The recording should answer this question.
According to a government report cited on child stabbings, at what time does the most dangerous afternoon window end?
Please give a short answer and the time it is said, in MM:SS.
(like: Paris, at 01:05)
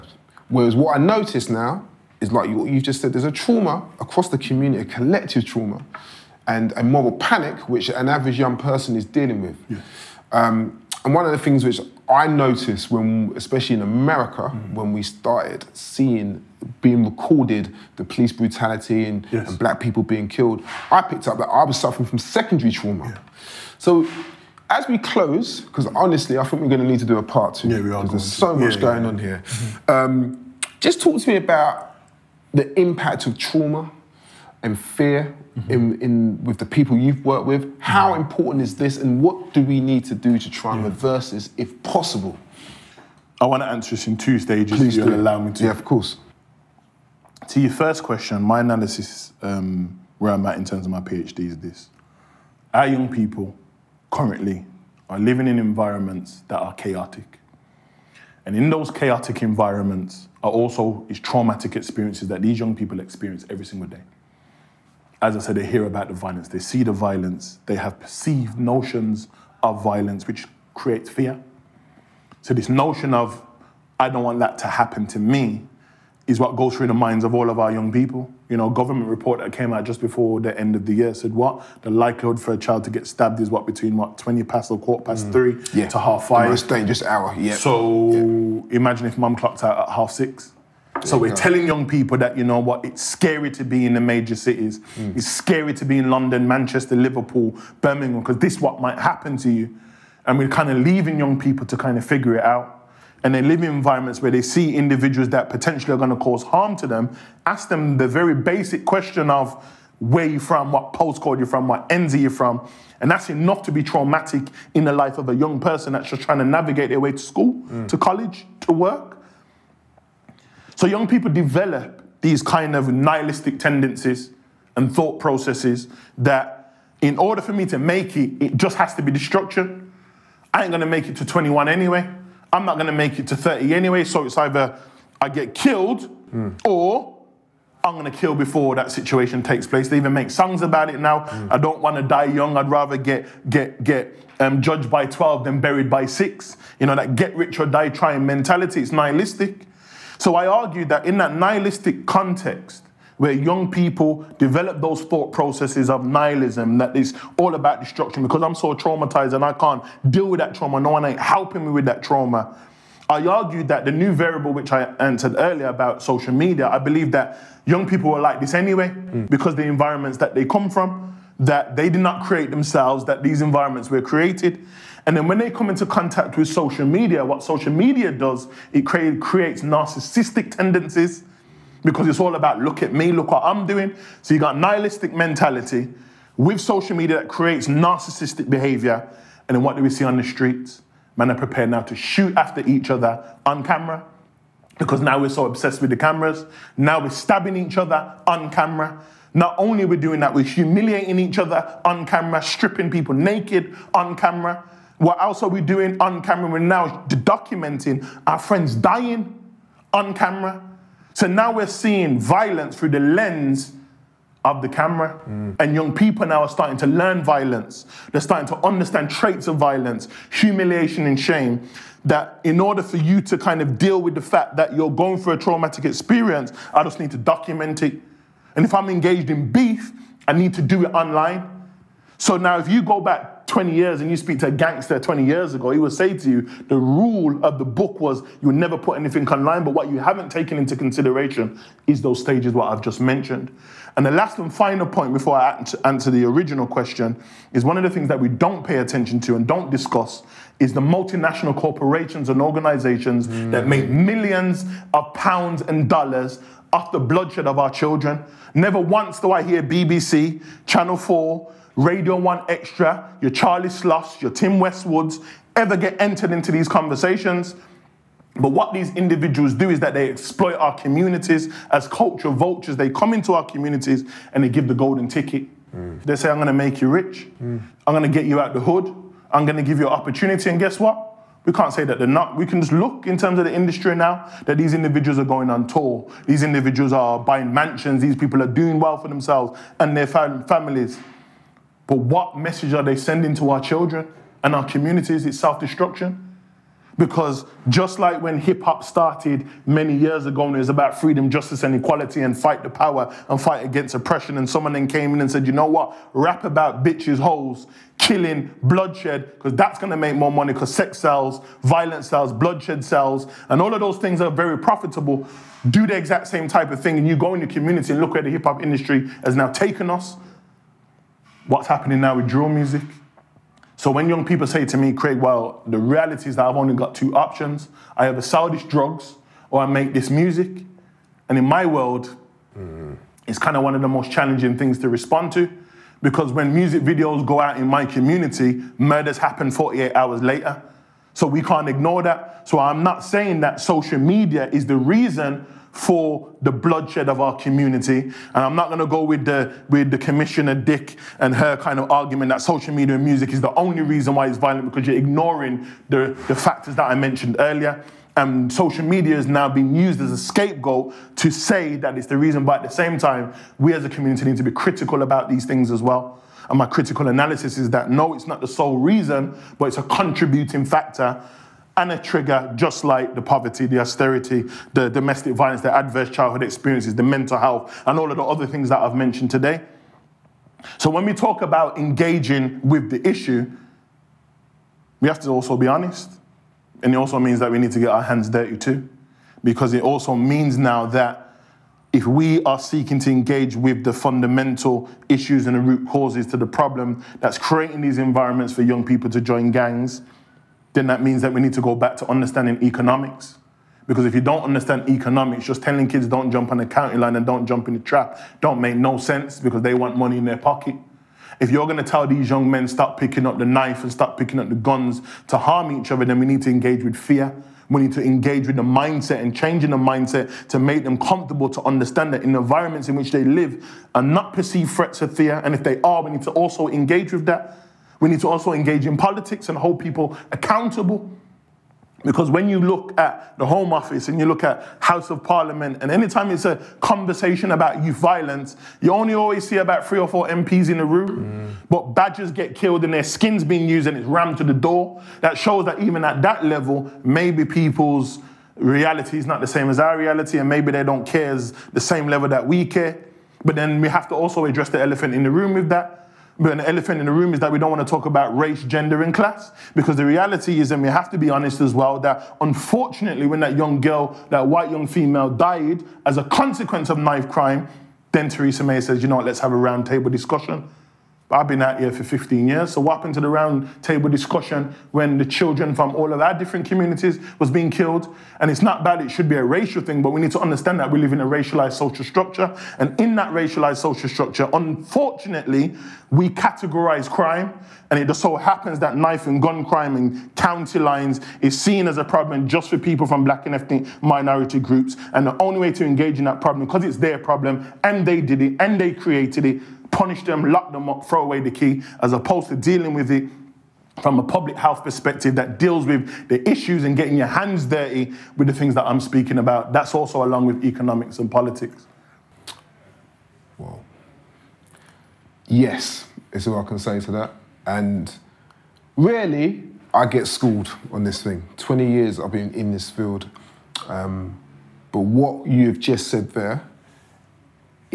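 half five, at 01:25.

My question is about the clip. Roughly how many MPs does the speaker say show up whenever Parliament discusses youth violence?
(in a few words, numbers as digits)
3 or 4.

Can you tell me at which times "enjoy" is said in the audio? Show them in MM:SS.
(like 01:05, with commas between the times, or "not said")
not said.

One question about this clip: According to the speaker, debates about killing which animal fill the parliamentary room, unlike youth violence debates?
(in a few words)
Badgers.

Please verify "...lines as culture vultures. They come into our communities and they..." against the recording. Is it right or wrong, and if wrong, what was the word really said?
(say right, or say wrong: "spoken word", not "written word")
wrong: "communities", not "lines".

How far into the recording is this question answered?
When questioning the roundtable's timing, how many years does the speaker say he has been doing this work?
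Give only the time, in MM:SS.
07:52.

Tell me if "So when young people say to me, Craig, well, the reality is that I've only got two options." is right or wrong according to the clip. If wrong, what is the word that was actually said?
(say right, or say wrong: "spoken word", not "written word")
right.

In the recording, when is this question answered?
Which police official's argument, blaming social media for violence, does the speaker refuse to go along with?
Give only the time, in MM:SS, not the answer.
05:49.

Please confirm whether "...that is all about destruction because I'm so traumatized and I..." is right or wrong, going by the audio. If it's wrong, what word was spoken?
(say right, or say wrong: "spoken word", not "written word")
right.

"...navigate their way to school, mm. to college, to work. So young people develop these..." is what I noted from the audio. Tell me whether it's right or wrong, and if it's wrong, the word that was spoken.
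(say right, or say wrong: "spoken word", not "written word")
right.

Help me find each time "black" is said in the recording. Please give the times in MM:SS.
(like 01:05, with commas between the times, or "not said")
00:19, 08:13.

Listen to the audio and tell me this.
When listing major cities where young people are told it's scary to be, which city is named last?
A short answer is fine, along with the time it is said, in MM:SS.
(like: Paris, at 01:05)
Birmingham, at 01:37.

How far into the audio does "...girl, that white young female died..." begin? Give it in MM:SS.
07:43.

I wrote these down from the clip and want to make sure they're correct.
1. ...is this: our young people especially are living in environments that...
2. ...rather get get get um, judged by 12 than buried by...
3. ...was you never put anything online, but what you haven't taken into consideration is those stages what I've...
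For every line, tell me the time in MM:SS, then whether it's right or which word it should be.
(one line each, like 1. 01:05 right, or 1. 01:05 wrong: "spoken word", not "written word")
1. 00:51 wrong: "currently", not "especially"
2. 02:22 right
3. 03:57 right.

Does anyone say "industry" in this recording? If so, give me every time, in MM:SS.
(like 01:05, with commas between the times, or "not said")
04:43, 05:18.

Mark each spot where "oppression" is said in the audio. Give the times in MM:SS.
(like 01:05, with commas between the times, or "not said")
05:03.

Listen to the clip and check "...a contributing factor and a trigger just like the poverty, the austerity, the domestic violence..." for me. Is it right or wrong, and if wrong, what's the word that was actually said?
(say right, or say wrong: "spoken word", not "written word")
right.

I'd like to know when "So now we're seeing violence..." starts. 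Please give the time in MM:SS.
03:31.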